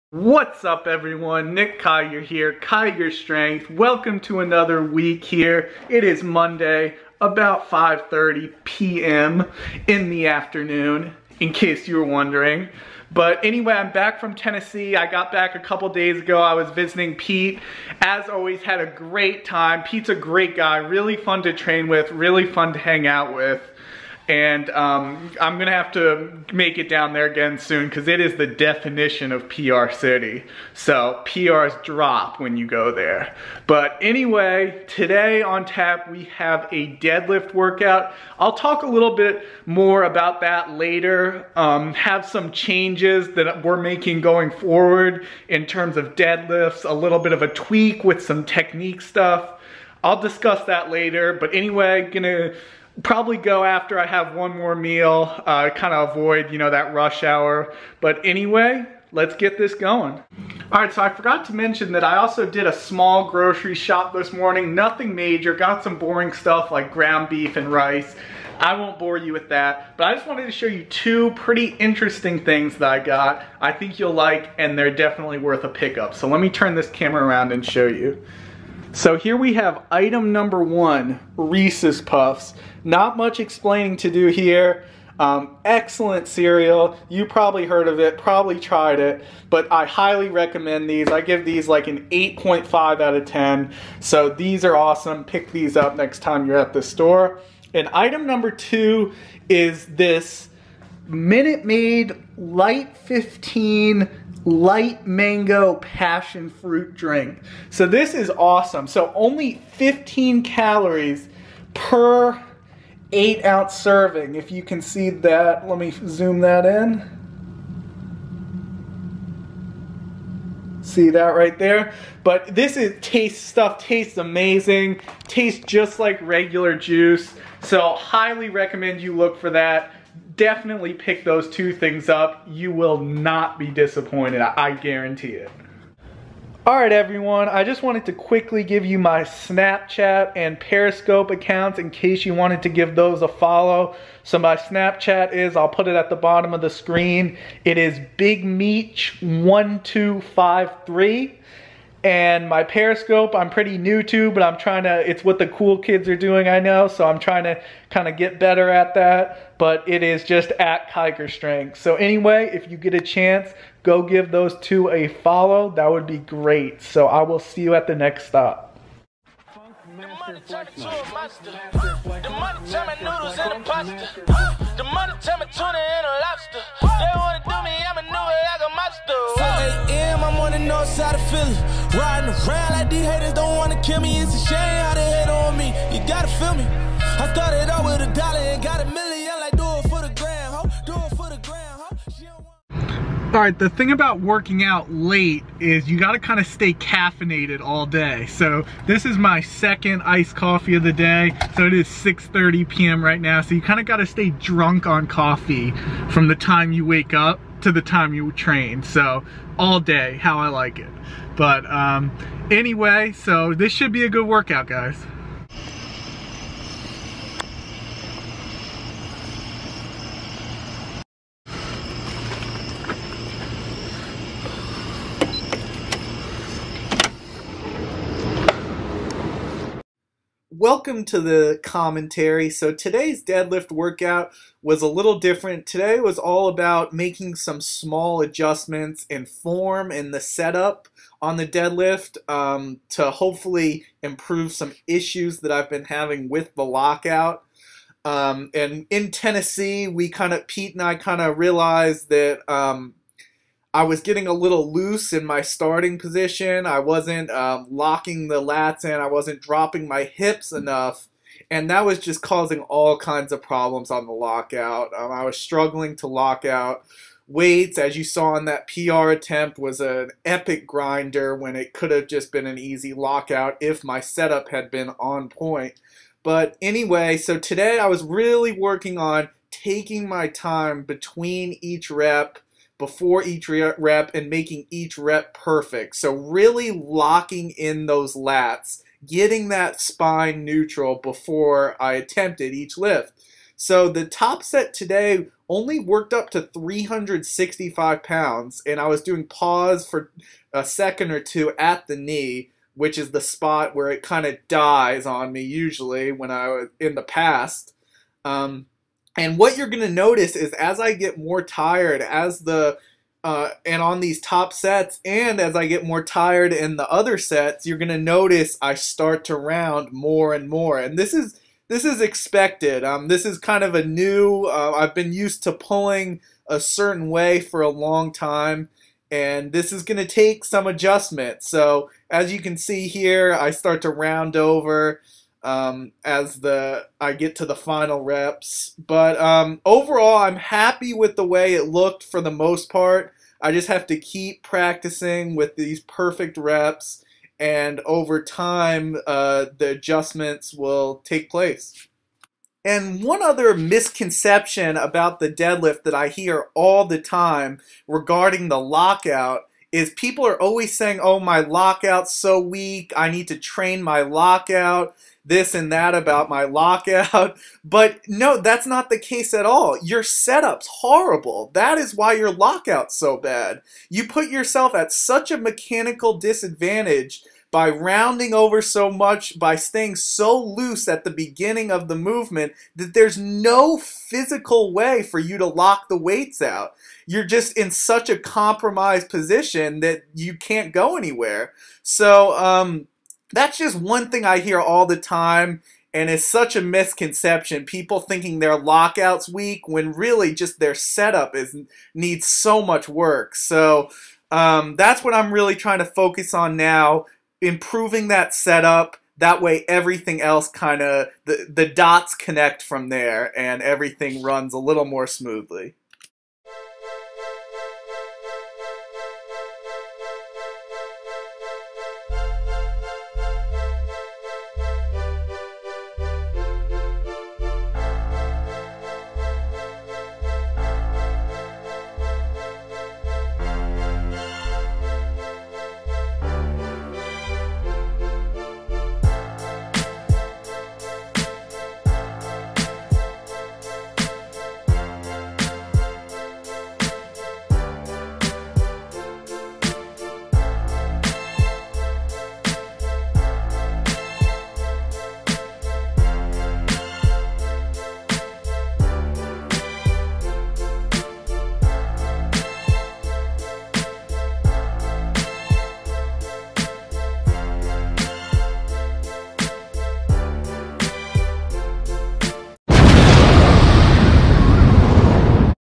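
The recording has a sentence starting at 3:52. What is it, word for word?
So today's deadlift workout was a little different.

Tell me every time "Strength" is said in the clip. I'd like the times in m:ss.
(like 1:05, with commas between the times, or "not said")
0:03, 2:41.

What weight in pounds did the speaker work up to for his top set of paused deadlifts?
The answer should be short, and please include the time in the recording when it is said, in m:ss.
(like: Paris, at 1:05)
365 pounds, at 4:56.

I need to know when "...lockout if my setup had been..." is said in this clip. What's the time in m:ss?
4:32.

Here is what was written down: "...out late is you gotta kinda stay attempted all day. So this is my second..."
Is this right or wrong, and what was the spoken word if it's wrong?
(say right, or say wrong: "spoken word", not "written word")
wrong: "caffeinated", not "attempted".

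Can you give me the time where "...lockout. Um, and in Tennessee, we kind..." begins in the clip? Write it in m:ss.
4:06.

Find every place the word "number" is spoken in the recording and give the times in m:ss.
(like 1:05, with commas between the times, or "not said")
1:20, 1:38.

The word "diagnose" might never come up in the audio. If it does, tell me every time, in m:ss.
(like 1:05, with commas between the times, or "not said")
not said.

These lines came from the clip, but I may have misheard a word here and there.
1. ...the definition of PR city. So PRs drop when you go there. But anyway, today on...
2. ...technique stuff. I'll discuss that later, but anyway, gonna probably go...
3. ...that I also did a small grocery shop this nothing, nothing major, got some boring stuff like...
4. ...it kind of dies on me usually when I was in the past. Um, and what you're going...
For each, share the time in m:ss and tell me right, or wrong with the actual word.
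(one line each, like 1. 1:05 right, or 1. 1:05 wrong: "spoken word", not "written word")
1. 0:28 right
2. 0:48 right
3. 1:01 wrong: "morning", not "nothing"
4. 5:03 right.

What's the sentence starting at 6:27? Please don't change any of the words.
You're just in such a compromised position that you can't go anywhere.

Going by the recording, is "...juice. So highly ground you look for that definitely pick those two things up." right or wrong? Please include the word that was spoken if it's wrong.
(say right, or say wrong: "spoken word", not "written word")
wrong: "recommend", not "ground".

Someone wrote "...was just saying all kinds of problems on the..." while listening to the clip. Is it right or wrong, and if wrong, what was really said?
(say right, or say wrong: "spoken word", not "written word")
wrong: "causing", not "saying".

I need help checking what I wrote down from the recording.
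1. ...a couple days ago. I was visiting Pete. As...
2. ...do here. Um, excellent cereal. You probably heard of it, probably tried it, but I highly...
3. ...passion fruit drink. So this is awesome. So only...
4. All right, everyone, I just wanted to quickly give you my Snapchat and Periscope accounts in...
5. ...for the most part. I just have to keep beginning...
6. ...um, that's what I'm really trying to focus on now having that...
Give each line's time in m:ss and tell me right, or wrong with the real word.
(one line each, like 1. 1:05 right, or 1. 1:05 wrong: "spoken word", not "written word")
1. 0:15 right
2. 1:24 right
3. 1:45 right
4. 2:16 right
5. 5:42 wrong: "practicing", not "beginning"
6. 6:44 wrong: "improving", not "having".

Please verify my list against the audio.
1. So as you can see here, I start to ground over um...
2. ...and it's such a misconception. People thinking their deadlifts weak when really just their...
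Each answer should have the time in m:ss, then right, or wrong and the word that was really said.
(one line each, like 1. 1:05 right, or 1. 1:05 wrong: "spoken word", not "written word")
1. 5:31 wrong: "round", not "ground"
2. 6:35 wrong: "lockouts", not "deadlifts".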